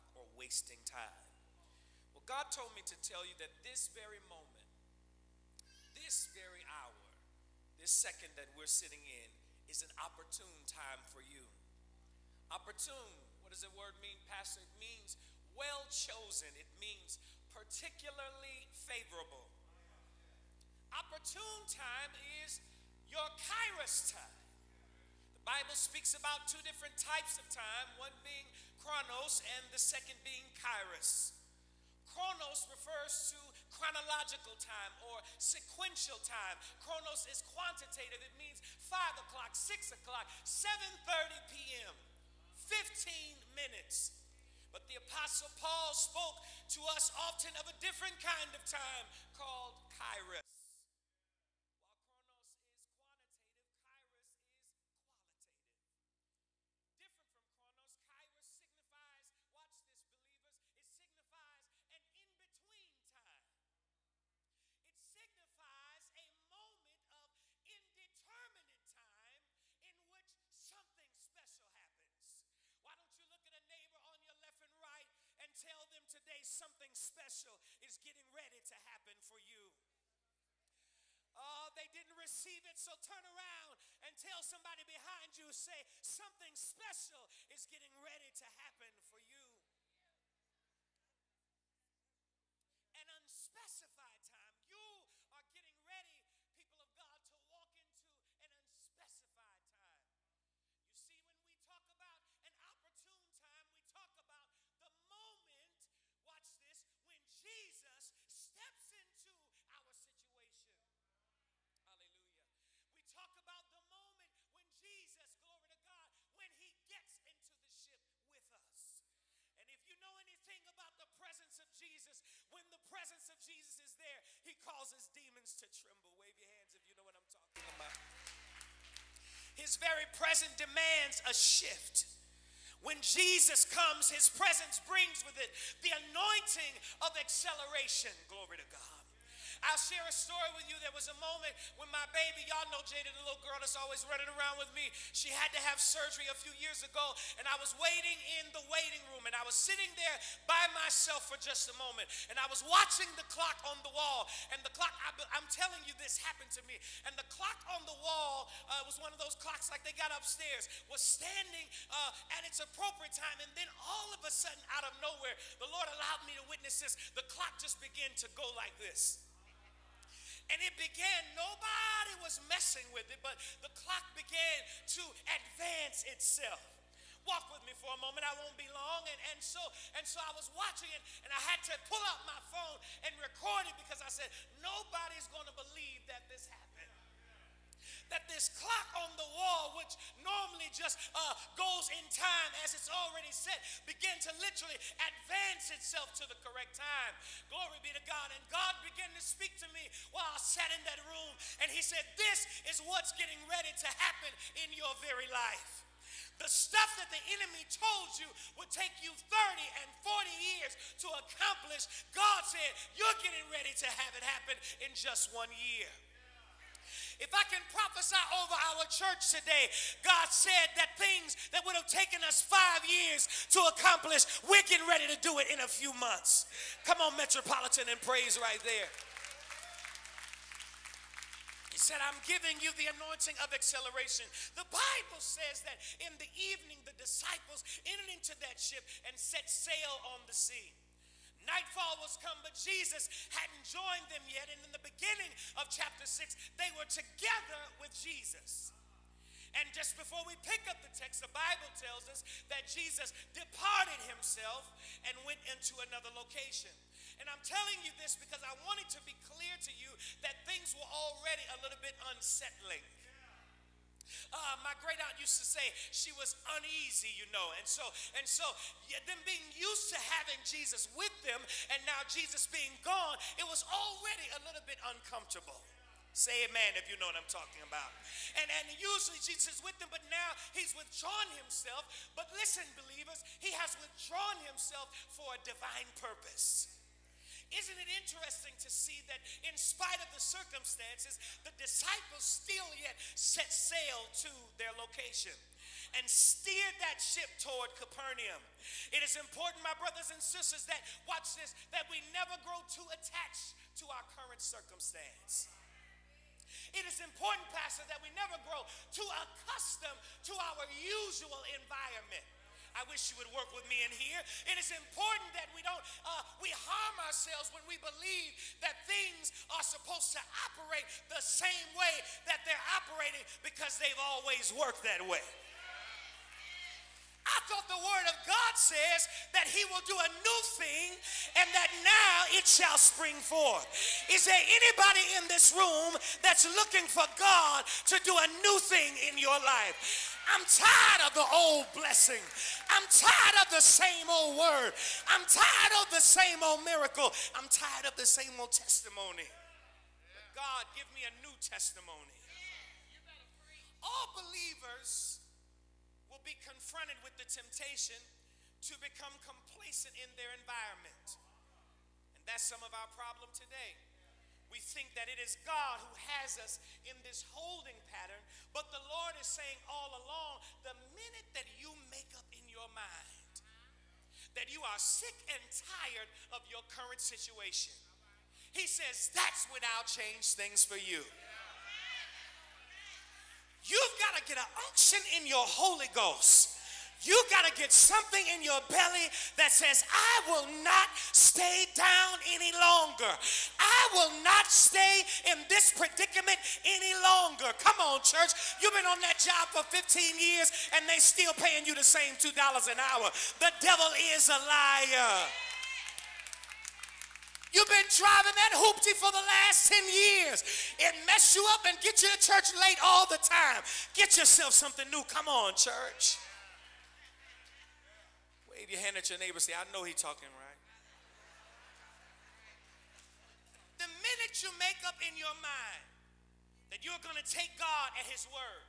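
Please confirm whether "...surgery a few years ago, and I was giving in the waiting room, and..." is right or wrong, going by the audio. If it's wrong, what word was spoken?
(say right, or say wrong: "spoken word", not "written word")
wrong: "waiting", not "giving".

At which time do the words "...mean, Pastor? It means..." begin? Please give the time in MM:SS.
00:14.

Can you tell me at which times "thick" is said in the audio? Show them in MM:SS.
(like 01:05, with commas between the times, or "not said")
not said.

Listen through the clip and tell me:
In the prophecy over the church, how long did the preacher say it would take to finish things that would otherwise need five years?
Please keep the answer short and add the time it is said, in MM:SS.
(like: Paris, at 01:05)
a few months, at 03:45.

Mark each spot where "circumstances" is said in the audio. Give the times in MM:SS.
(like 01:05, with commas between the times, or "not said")
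04:50, 05:04.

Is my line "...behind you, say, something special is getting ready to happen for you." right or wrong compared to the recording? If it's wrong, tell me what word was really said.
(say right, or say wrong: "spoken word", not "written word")
right.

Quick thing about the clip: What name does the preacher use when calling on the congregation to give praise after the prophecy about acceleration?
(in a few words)
Metropolitan.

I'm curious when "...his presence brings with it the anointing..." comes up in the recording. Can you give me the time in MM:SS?
02:14.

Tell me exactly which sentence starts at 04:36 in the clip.
Say amen if you know what I'm talking about.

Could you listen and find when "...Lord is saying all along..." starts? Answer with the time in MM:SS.
06:08.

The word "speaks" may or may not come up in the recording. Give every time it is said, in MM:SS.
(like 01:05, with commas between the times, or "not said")
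00:25, 03:19.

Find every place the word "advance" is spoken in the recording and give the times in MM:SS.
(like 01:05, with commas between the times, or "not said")
02:55, 03:15.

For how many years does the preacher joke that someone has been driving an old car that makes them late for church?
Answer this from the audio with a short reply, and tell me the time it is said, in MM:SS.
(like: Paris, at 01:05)
10, at 06:49.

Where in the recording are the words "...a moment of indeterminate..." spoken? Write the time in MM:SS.
01:06.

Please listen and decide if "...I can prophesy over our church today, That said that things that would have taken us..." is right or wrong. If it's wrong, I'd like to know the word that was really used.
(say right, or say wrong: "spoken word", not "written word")
wrong: "God", not "That".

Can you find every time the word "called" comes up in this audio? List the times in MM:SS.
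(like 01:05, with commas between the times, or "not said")
00:49.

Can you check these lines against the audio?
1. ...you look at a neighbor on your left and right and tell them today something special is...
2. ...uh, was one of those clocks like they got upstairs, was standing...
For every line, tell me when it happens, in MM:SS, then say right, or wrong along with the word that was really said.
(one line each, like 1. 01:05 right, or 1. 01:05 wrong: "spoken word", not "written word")
1. 01:13 right
2. 02:38 right.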